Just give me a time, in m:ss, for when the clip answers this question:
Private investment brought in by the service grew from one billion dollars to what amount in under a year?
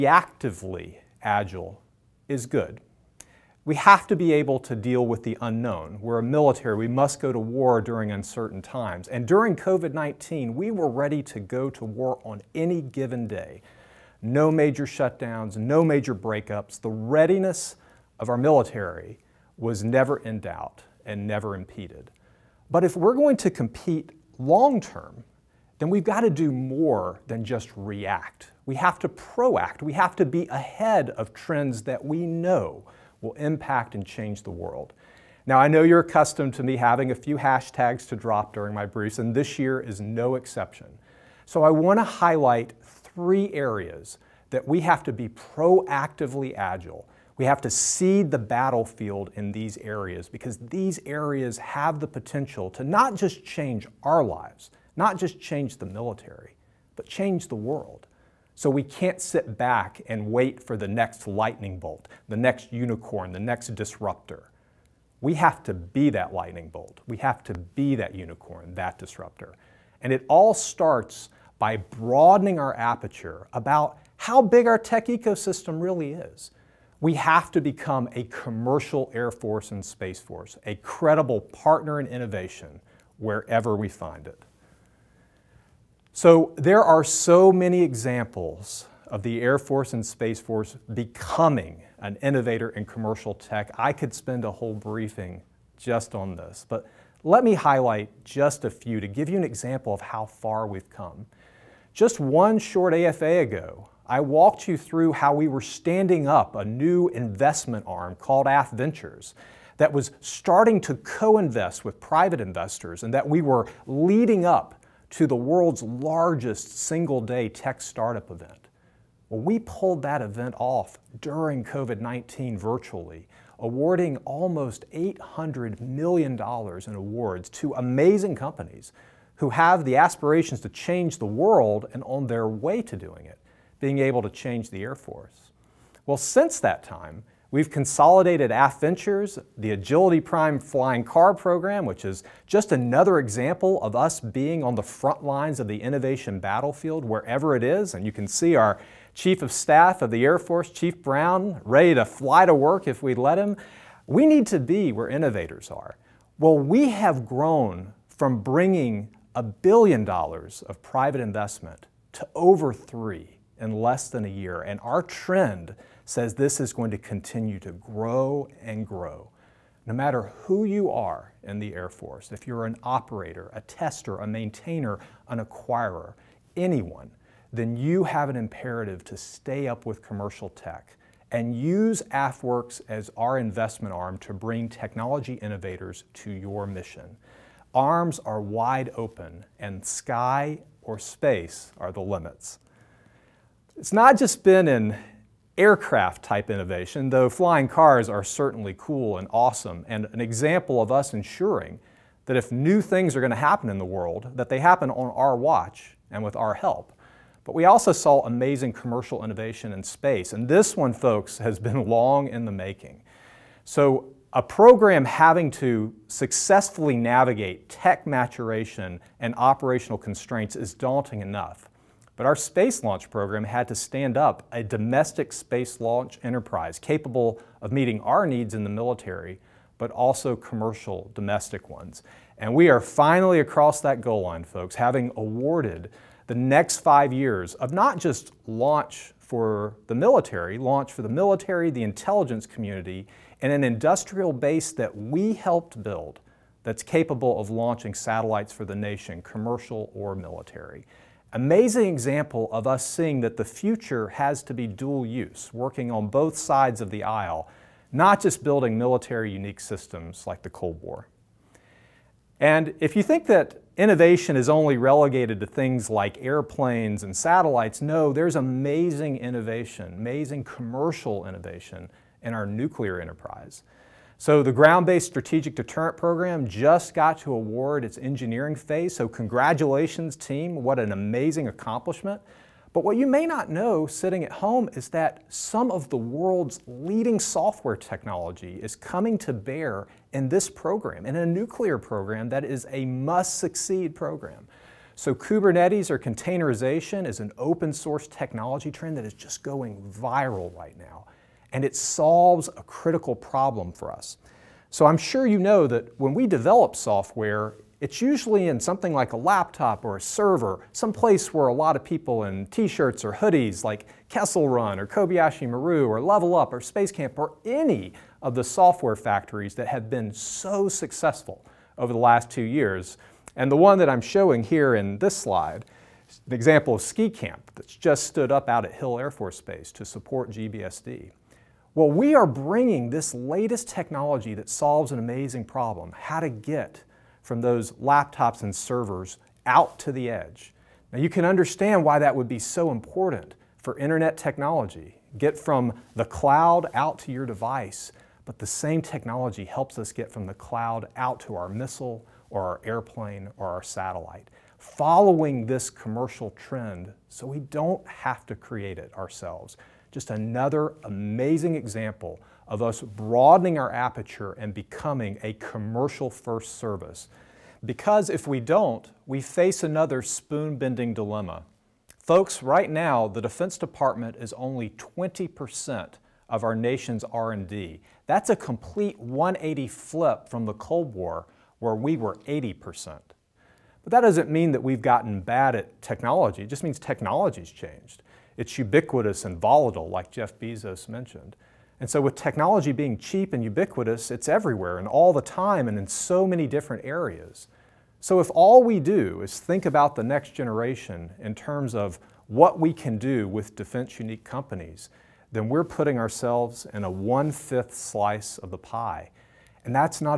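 2:42.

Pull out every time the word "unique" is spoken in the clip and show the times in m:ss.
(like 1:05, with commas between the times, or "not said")
4:19, 6:43.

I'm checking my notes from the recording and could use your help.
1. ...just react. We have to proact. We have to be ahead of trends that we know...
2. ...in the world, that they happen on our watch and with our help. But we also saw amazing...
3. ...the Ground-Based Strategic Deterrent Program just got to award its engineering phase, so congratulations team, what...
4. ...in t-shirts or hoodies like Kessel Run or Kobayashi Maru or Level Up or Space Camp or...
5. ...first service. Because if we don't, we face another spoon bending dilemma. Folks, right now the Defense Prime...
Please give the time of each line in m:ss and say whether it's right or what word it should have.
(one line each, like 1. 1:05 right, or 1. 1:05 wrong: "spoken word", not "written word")
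1. 0:27 right
2. 3:23 right
3. 4:34 right
4. 5:12 right
5. 6:06 wrong: "Department", not "Prime".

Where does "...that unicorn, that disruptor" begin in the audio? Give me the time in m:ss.
1:07.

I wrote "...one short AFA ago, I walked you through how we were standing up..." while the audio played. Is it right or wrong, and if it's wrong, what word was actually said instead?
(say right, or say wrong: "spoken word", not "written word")
right.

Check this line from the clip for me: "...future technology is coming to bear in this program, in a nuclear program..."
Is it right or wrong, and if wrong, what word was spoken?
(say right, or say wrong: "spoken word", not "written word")
wrong: "software", not "future".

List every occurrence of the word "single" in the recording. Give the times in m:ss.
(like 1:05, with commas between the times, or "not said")
1:56.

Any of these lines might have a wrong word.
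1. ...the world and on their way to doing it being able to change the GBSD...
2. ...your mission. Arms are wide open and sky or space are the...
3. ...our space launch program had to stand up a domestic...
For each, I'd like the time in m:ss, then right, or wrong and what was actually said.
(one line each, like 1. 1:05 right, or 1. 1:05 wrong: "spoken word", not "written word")
1. 2:11 wrong: "Air", not "GBSD"
2. 3:06 right
3. 3:42 right.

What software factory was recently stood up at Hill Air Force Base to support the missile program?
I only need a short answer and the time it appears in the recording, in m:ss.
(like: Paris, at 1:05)
Ski Camp, at 5:26.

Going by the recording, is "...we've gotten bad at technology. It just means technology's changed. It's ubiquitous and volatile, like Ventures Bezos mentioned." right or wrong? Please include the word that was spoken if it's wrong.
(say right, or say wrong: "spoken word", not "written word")
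wrong: "Jeff", not "Ventures".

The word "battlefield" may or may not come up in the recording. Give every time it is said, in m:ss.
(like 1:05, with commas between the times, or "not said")
0:48, 2:26.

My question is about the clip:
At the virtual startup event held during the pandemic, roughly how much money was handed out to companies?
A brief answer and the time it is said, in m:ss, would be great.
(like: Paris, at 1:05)
almost $800 million, at 2:04.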